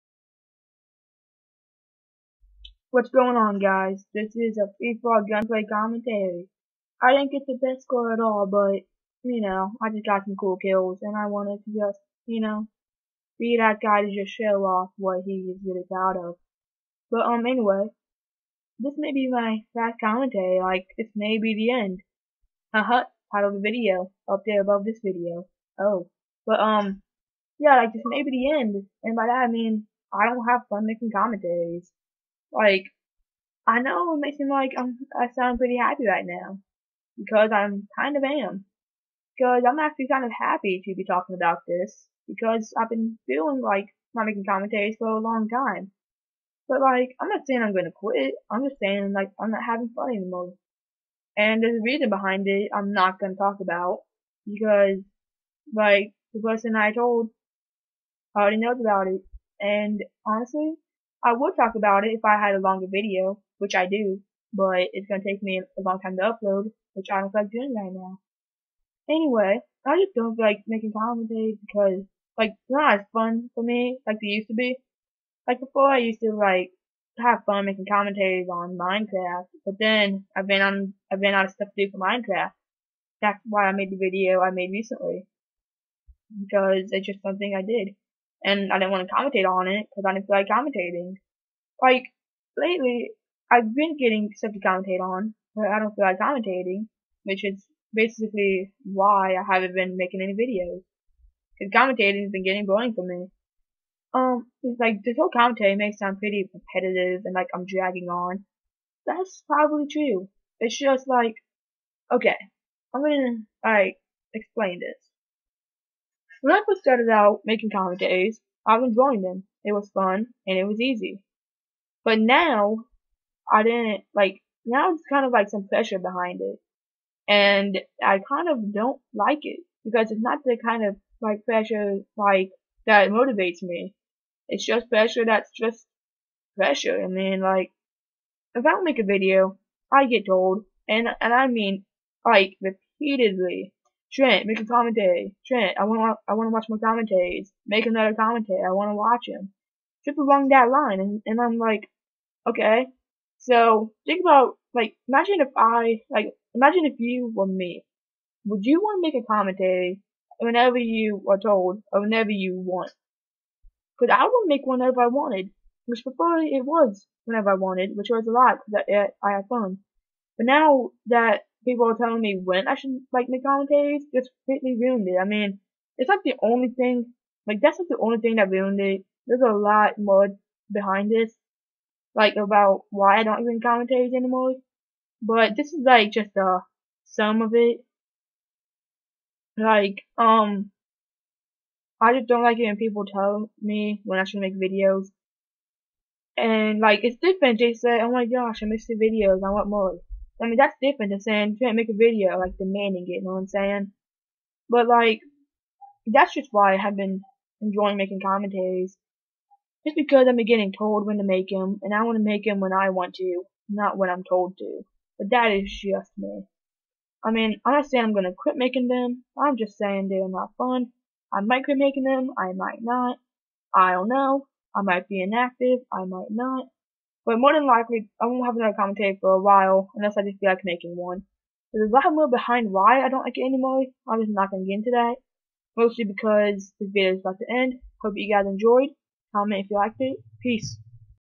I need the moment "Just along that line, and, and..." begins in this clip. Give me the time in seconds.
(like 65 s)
150 s.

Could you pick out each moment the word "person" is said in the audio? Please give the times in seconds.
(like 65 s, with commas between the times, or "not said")
56 s.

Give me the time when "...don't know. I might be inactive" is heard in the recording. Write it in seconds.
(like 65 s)
223 s.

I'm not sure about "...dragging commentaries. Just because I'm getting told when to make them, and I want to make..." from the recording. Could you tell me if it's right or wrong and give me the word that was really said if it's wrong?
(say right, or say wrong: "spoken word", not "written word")
wrong: "making", not "dragging".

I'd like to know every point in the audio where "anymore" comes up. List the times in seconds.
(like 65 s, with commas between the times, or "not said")
50 s, 184 s, 233 s.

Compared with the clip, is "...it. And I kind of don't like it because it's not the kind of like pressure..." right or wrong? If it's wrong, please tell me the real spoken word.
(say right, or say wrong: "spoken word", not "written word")
right.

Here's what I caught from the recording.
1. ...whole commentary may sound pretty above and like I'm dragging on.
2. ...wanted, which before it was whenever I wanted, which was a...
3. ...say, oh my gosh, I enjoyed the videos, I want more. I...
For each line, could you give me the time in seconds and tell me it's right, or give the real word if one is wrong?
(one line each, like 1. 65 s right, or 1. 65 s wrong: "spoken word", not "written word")
1. 105 s wrong: "repetitive", not "above"
2. 165 s right
3. 197 s wrong: "missed", not "enjoyed".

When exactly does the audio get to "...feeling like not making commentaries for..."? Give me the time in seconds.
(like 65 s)
43 s.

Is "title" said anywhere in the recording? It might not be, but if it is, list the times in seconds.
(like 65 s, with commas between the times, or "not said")
23 s.